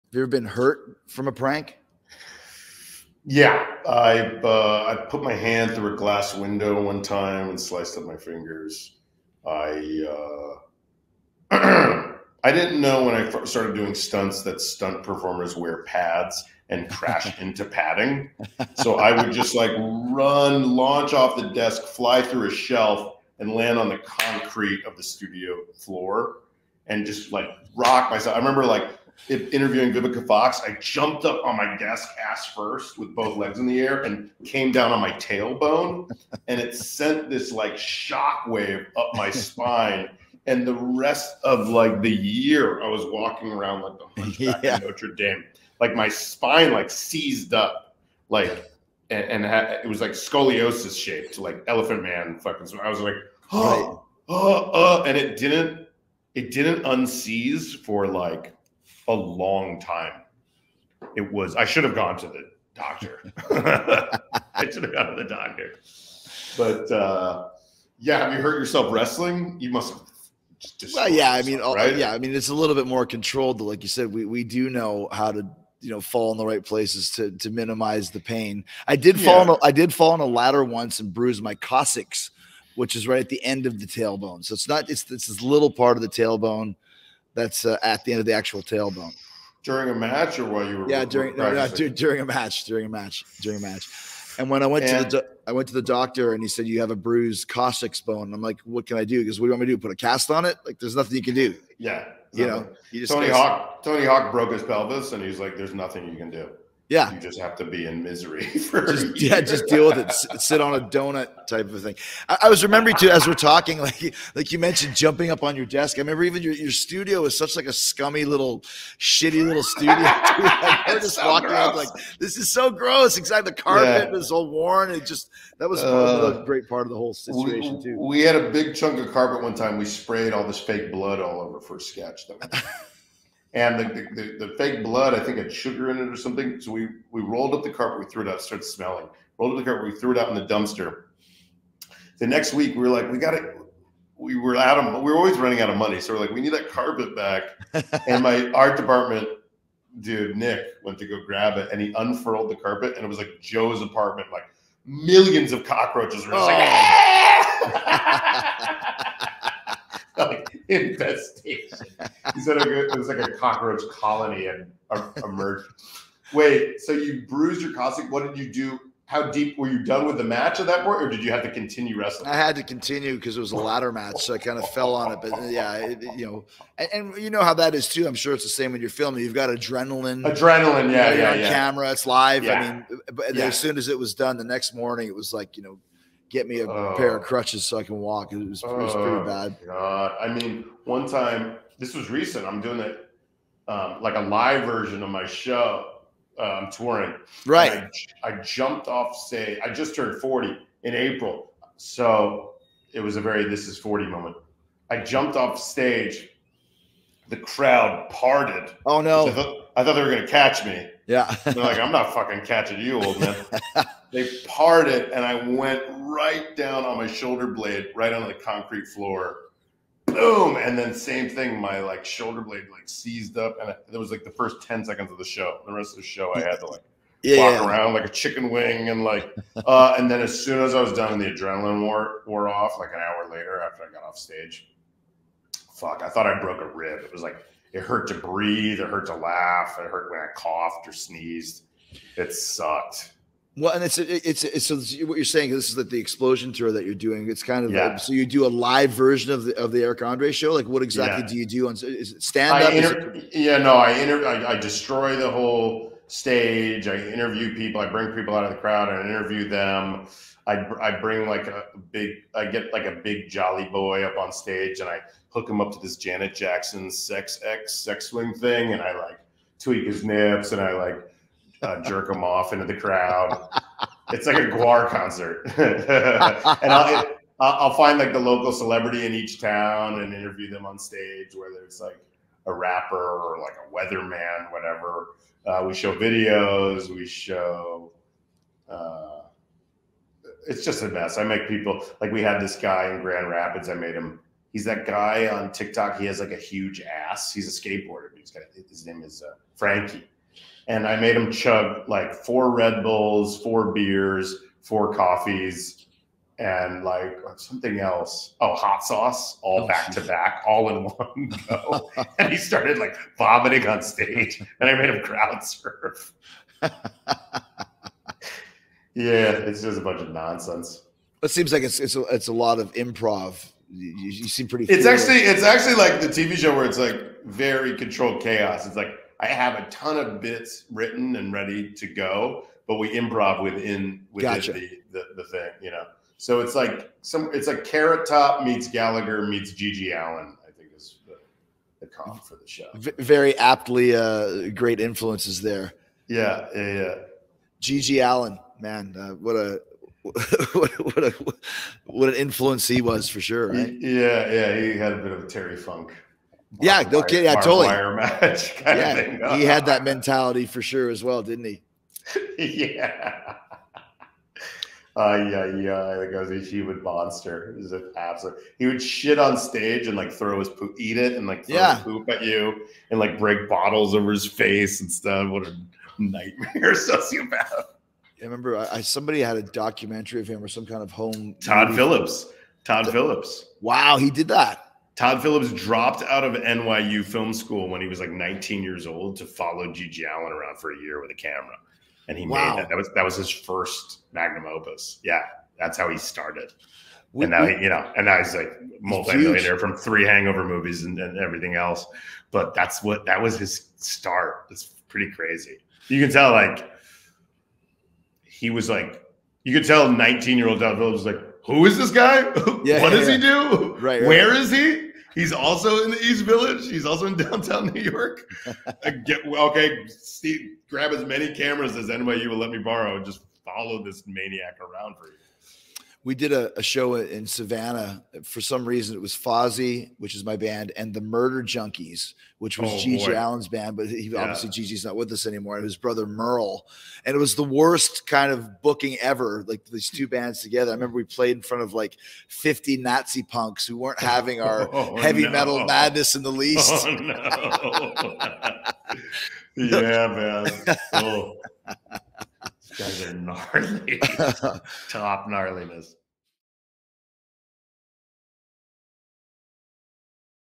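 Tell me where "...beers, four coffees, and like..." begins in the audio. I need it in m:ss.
5:03.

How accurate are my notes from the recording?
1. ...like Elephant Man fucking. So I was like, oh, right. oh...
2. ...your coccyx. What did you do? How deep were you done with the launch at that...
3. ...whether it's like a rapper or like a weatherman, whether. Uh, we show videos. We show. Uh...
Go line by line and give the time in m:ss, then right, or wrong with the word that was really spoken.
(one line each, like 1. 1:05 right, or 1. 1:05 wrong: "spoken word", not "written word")
1. 0:51 right
2. 2:47 wrong: "match", not "launch"
3. 4:41 wrong: "whatever", not "whether".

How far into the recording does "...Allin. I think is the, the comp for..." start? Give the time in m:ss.
5:39.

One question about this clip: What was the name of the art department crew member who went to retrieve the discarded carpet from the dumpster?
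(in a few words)
Nick.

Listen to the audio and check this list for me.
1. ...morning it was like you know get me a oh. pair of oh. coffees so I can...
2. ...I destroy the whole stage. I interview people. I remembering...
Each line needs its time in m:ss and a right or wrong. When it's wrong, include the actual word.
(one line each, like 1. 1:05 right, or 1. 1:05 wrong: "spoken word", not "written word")
1. 3:04 wrong: "crutches", not "coffees"
2. 4:14 wrong: "bring", not "remembering".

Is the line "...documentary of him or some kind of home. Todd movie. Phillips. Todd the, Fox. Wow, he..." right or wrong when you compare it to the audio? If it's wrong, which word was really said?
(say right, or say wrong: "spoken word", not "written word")
wrong: "Phillips", not "Fox".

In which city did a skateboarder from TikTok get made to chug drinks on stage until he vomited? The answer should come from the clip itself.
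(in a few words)
Grand Rapids.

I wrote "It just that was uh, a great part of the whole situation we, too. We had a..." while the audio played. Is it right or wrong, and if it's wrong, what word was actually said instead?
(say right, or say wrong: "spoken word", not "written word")
right.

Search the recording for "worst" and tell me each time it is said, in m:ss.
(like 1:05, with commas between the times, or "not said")
7:17.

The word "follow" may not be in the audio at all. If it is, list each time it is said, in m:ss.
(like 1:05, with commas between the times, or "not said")
6:29, 7:03.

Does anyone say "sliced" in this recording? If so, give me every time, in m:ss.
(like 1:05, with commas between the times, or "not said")
0:07.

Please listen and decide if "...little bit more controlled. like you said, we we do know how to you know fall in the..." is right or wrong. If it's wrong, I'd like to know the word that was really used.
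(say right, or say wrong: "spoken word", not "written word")
right.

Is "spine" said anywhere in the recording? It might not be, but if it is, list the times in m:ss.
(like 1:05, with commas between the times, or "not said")
0:39, 0:46.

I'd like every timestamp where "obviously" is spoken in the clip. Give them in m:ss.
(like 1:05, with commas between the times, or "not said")
7:14.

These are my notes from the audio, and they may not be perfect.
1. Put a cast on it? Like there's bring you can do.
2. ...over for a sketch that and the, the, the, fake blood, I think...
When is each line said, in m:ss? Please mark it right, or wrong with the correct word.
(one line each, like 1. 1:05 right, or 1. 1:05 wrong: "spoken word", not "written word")
1. 1:39 wrong: "nothing", not "bring"
2. 2:11 right.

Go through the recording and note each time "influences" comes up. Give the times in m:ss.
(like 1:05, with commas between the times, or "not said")
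5:44, 5:52.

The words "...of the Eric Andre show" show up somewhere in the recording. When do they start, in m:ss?
4:09.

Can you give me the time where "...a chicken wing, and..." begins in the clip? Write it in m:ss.
3:48.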